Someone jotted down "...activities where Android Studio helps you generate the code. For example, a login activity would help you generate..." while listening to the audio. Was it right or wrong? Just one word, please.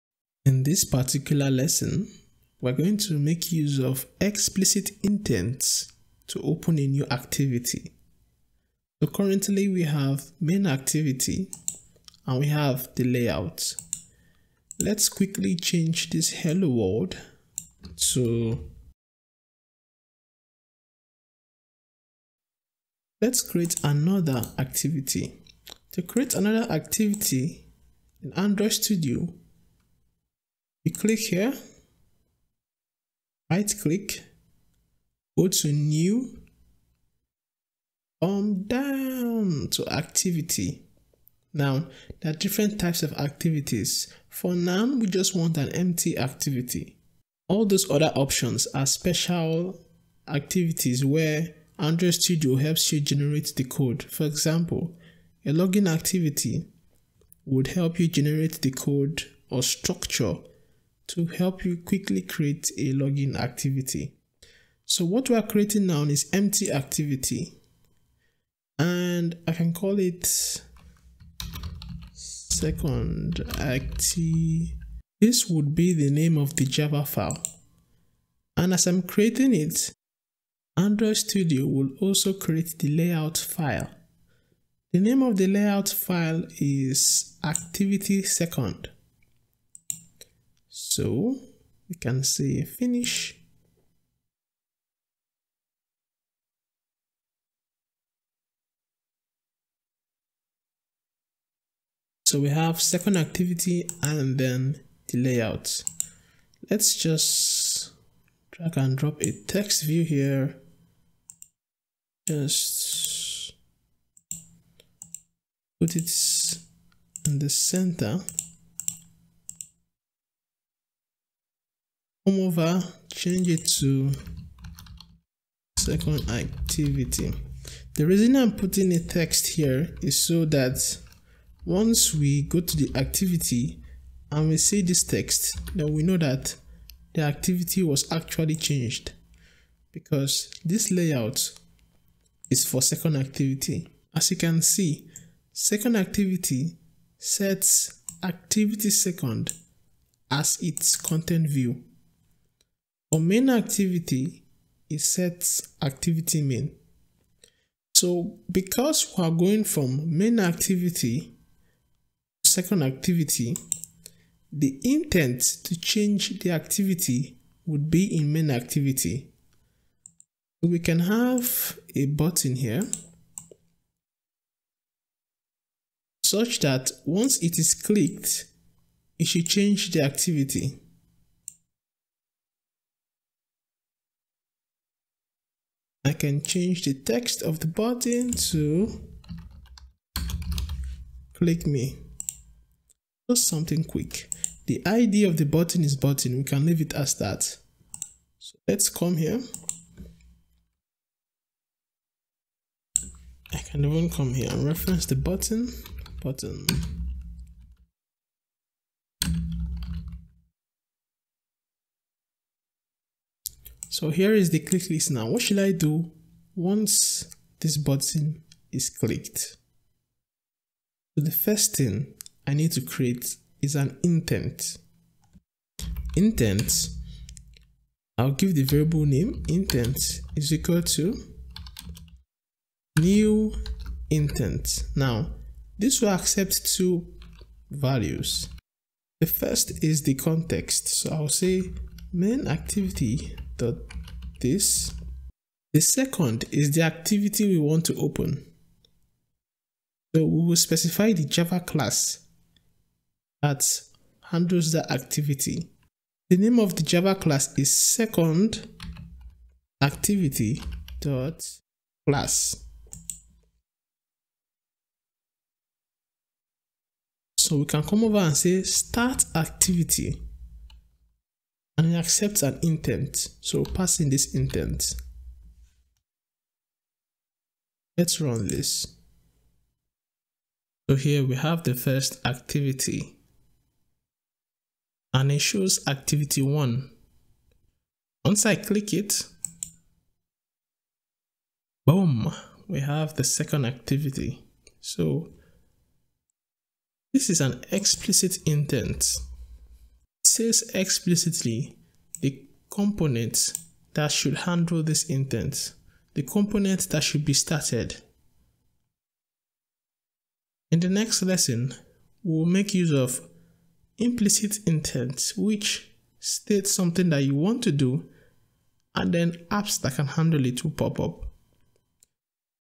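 right.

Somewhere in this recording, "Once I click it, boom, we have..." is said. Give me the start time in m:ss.
4:48.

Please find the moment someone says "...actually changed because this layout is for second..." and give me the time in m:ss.
2:18.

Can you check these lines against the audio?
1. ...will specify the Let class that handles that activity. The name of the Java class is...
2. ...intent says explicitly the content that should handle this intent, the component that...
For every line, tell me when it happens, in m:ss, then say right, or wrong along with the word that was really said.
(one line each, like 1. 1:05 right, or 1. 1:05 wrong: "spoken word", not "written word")
1. 4:10 wrong: "Java", not "Let"
2. 4:58 wrong: "component", not "content".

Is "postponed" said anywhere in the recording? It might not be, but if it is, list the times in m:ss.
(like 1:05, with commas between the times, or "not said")
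not said.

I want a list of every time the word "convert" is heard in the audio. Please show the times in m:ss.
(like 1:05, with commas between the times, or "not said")
not said.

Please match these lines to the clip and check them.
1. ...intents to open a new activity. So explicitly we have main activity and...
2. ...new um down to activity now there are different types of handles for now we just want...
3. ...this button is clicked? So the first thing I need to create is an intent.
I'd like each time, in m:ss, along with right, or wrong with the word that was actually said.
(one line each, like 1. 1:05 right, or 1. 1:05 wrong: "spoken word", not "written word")
1. 0:05 wrong: "currently", not "explicitly"
2. 0:35 wrong: "activities", not "handles"
3. 3:37 right.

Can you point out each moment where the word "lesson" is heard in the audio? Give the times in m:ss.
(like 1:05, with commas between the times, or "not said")
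0:01, 5:11.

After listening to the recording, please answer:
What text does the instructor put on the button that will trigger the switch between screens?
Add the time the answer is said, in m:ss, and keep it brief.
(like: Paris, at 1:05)
click me, at 3:11.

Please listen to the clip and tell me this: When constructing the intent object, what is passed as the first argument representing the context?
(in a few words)
main activity dot this.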